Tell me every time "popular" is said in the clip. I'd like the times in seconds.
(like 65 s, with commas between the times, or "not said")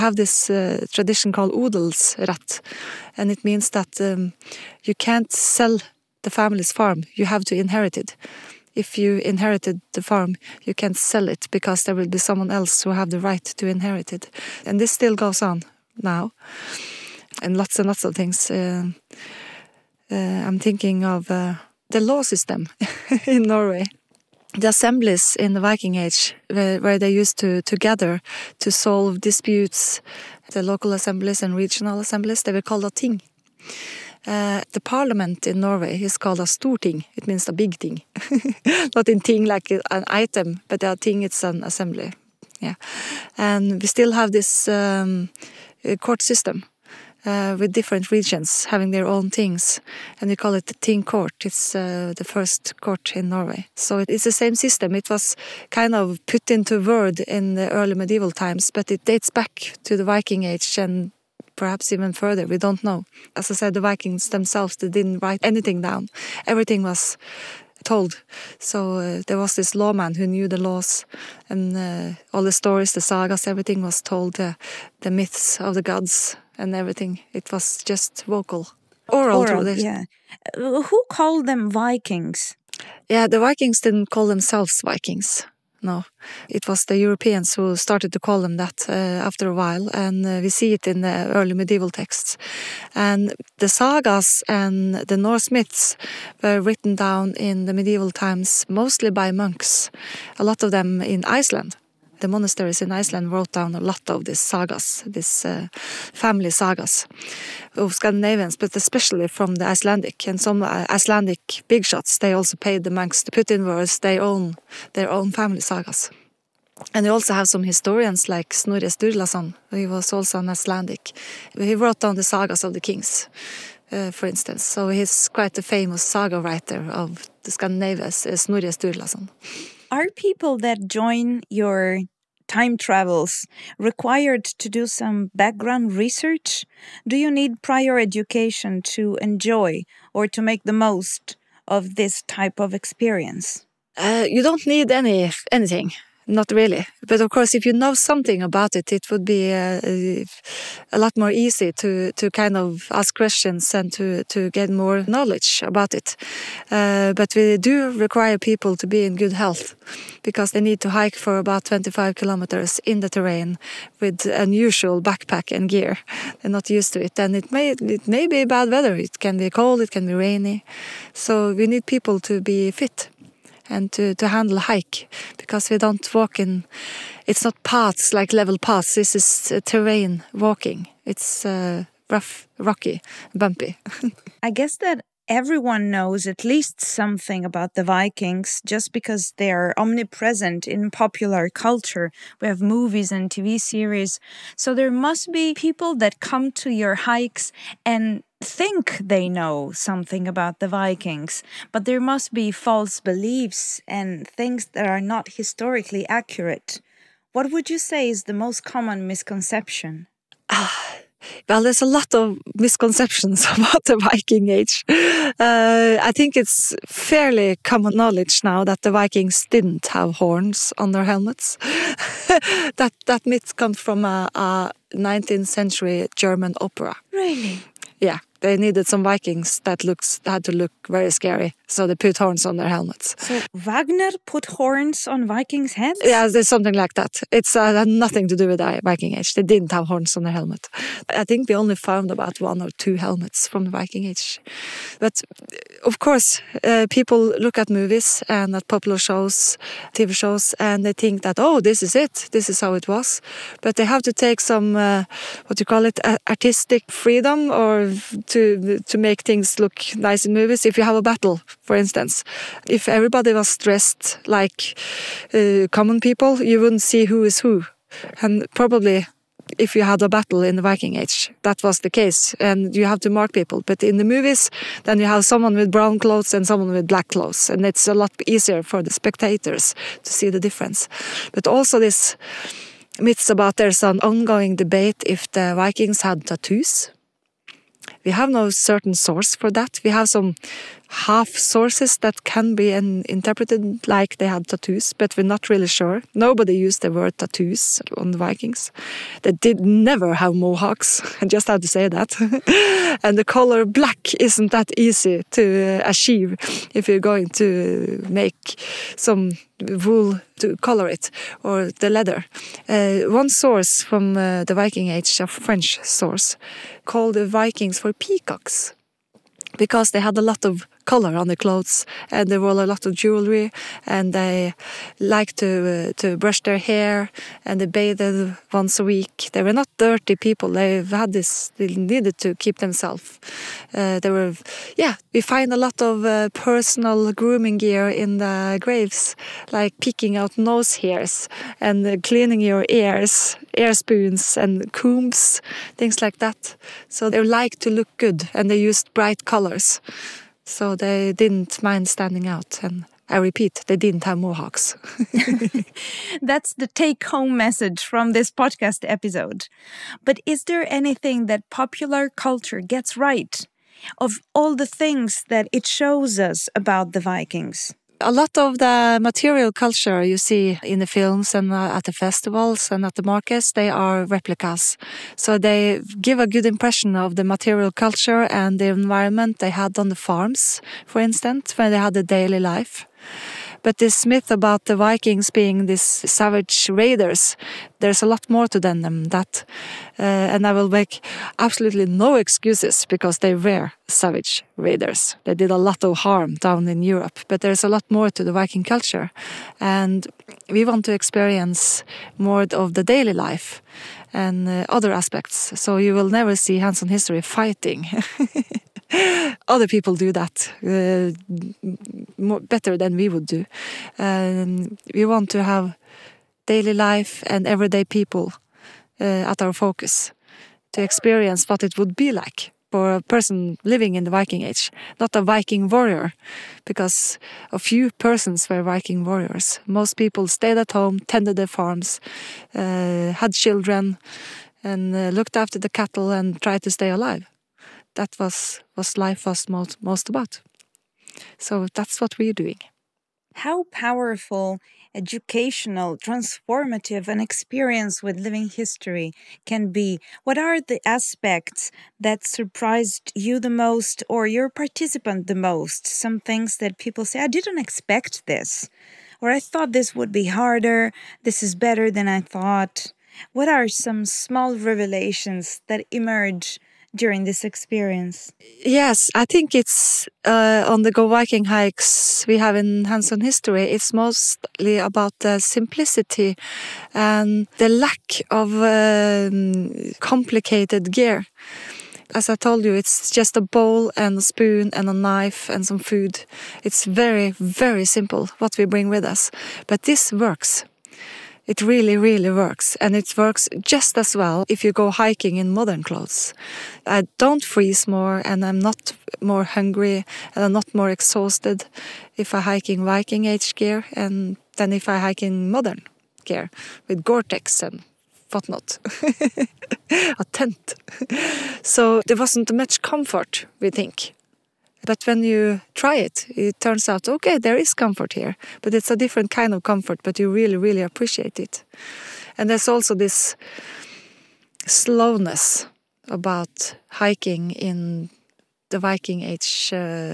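190 s, 248 s, 361 s.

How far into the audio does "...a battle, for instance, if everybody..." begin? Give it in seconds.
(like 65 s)
260 s.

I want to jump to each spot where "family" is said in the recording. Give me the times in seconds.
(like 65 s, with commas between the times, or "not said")
6 s, 106 s, 115 s.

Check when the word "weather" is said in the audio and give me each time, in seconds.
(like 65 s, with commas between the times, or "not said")
168 s.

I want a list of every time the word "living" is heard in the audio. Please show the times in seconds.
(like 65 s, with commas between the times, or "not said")
423 s, 448 s.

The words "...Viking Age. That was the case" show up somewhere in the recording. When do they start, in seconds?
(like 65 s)
270 s.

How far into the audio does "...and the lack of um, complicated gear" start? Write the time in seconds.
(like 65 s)
476 s.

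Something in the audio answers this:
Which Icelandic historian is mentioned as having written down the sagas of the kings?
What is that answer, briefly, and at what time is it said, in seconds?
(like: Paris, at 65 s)
Snorri Sturlason, at 118 s.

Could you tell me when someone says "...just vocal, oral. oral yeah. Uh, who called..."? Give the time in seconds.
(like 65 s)
77 s.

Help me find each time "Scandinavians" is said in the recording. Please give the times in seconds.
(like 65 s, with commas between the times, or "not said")
107 s, 127 s.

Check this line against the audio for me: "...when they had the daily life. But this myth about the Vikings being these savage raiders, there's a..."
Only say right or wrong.
right.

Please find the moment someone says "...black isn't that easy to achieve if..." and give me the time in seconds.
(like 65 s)
303 s.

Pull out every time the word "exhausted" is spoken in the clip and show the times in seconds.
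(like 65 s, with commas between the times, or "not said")
500 s.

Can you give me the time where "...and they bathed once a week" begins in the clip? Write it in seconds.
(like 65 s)
327 s.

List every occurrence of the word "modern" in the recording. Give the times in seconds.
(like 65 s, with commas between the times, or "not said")
495 s, 505 s.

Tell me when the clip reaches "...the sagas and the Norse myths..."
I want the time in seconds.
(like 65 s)
93 s.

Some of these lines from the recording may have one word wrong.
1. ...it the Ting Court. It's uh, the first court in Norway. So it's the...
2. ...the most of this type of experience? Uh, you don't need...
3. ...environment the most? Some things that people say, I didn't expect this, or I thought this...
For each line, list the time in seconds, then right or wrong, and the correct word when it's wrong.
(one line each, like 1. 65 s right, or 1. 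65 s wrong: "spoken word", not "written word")
1. 50 s right
2. 140 s right
3. 454 s wrong: "participant", not "environment".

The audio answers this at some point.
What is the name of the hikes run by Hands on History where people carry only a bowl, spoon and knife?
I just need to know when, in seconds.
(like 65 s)
470 s.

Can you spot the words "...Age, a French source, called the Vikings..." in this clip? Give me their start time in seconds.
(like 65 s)
314 s.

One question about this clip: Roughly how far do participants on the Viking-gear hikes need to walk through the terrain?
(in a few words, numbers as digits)
25 kilometers.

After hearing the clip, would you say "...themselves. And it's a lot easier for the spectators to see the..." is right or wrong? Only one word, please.
wrong.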